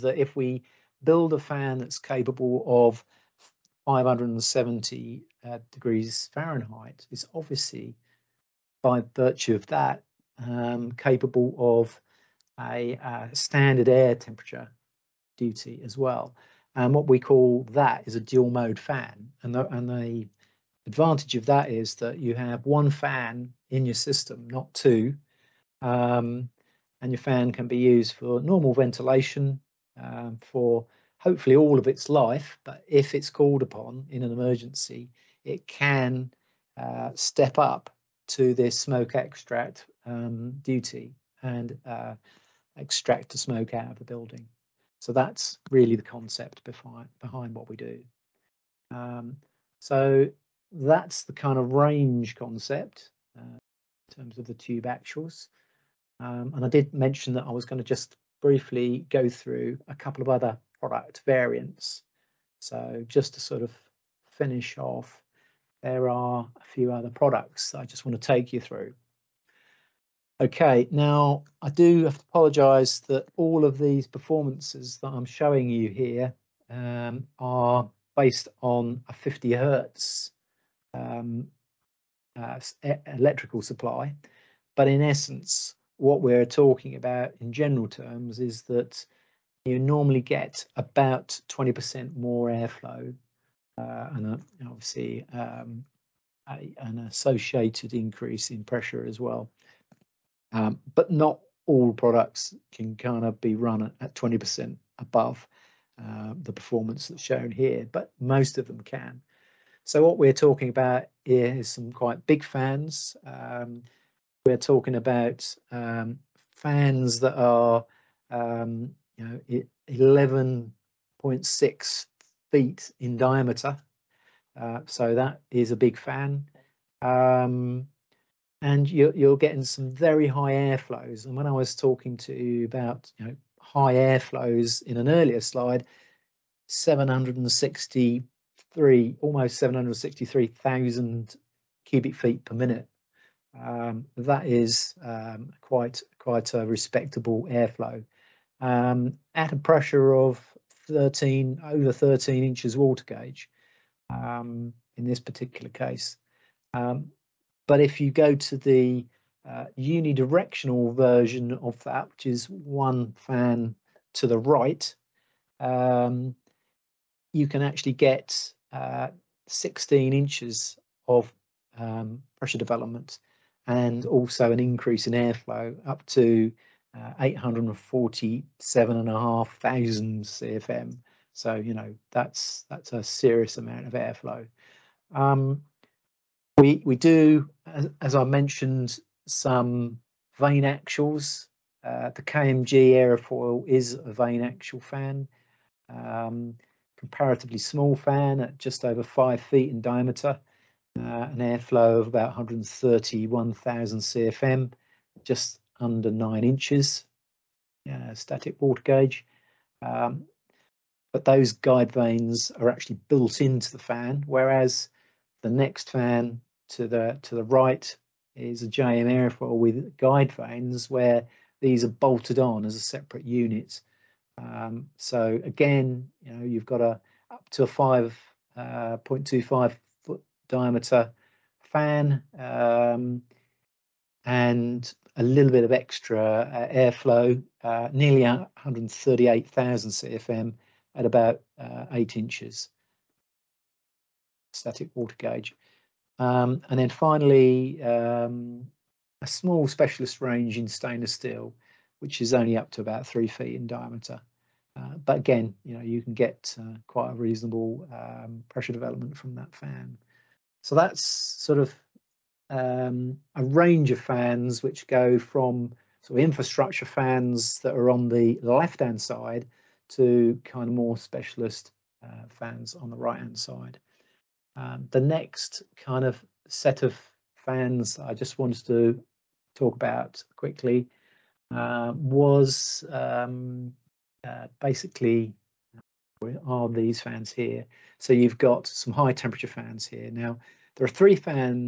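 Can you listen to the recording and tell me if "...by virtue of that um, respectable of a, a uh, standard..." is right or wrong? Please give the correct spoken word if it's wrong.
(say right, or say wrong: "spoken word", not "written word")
wrong: "capable", not "respectable".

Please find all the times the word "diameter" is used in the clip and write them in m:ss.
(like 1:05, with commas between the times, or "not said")
2:03, 3:19, 3:50, 4:13.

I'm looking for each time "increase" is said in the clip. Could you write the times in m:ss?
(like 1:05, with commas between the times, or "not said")
1:37, 2:54.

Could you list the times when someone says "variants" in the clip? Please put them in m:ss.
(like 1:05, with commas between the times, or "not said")
1:01.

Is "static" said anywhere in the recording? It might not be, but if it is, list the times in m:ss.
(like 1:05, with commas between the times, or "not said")
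3:28, 4:04.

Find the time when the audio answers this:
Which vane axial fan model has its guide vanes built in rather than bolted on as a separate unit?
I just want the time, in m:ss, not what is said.
3:12.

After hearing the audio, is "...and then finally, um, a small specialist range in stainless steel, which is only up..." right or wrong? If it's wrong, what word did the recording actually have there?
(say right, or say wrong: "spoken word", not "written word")
right.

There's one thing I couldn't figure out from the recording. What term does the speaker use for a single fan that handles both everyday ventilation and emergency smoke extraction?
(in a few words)
dual mode fan.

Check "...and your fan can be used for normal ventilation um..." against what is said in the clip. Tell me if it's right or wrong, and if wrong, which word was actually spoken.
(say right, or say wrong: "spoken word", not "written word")
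right.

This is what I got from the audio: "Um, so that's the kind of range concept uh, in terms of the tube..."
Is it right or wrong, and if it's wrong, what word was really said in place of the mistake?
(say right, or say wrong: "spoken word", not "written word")
right.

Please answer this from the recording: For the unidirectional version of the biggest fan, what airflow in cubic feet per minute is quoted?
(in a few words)
847,500 CFM.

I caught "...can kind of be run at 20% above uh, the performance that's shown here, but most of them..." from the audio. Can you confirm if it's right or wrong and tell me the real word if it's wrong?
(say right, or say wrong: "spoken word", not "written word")
right.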